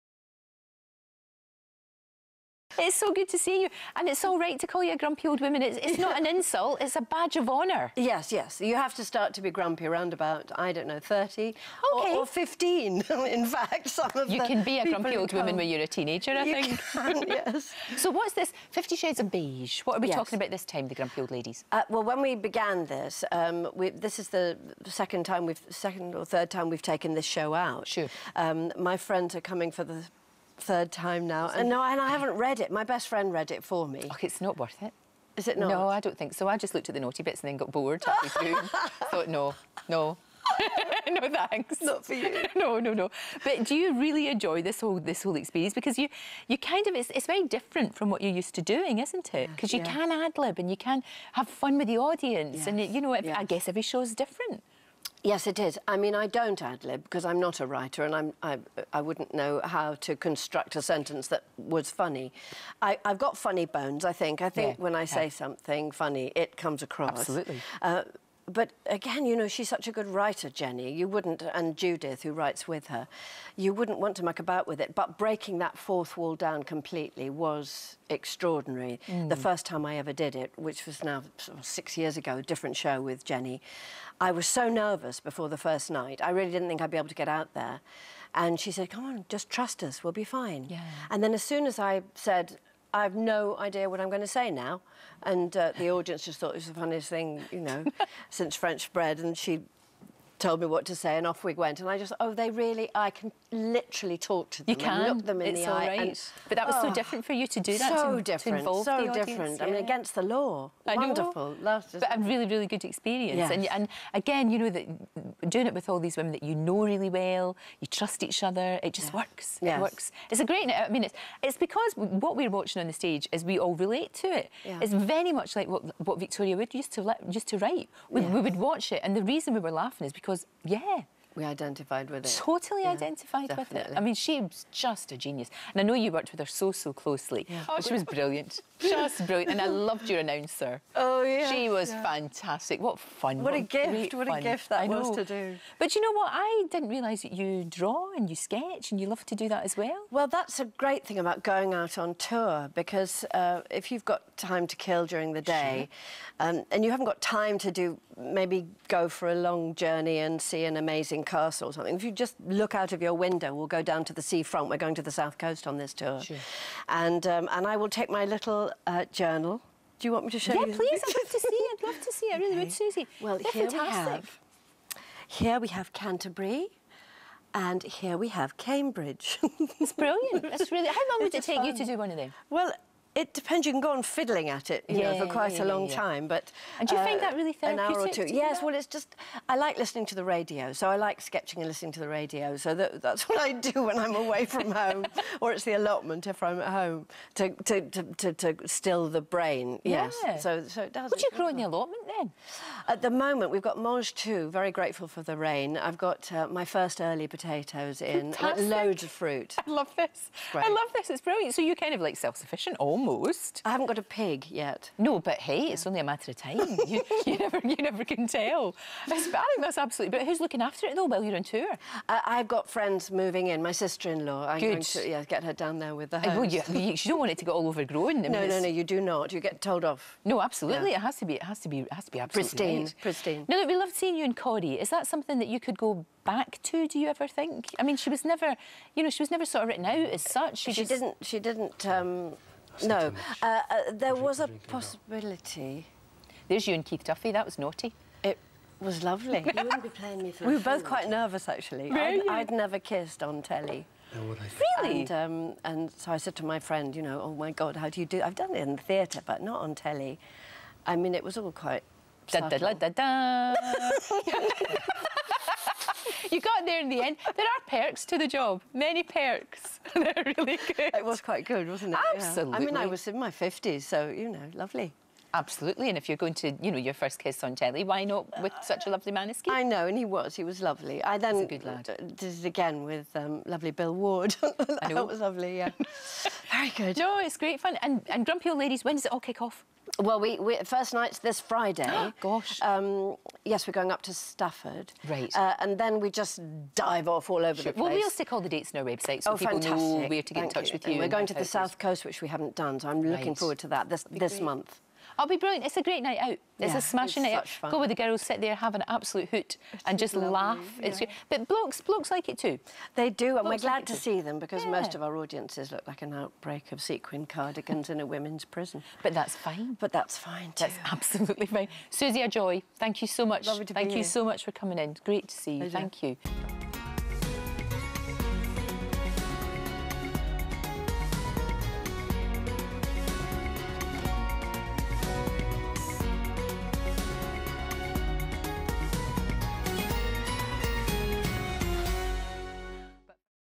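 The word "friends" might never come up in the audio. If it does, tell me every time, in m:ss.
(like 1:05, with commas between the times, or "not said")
0:28, 0:33, 3:42, 4:16.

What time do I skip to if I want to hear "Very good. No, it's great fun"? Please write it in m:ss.
4:46.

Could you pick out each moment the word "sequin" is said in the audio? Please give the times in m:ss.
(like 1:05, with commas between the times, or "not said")
5:16.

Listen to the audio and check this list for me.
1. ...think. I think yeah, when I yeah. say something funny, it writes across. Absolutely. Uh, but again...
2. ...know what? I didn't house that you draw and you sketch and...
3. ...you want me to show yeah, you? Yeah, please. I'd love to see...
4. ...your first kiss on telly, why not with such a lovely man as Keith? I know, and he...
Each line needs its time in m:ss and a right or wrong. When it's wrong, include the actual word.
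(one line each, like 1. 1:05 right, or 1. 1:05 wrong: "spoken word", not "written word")
1. 1:04 wrong: "comes", not "writes"
2. 2:26 wrong: "realise", not "house"
3. 2:50 right
4. 4:36 right.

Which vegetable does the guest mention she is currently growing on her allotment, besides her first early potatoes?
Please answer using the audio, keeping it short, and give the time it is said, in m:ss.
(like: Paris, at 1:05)
Mangetout, at 3:23.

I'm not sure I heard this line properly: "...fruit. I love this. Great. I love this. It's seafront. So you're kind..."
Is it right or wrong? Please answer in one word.
wrong.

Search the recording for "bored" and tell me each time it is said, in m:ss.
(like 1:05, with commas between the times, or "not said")
0:37.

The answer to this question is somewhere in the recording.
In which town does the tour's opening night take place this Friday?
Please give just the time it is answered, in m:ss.
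4:54.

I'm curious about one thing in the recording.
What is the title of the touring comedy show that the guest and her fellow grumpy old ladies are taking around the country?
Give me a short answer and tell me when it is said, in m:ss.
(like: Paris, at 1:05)
Fifty Shades of Beige, at 0:18.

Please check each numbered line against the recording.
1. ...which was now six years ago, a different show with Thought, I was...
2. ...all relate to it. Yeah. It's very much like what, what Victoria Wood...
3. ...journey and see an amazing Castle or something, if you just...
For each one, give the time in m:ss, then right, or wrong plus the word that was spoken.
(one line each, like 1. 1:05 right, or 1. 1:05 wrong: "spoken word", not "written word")
1. 1:20 wrong: "Jenny", not "Thought"
2. 2:03 right
3. 2:39 right.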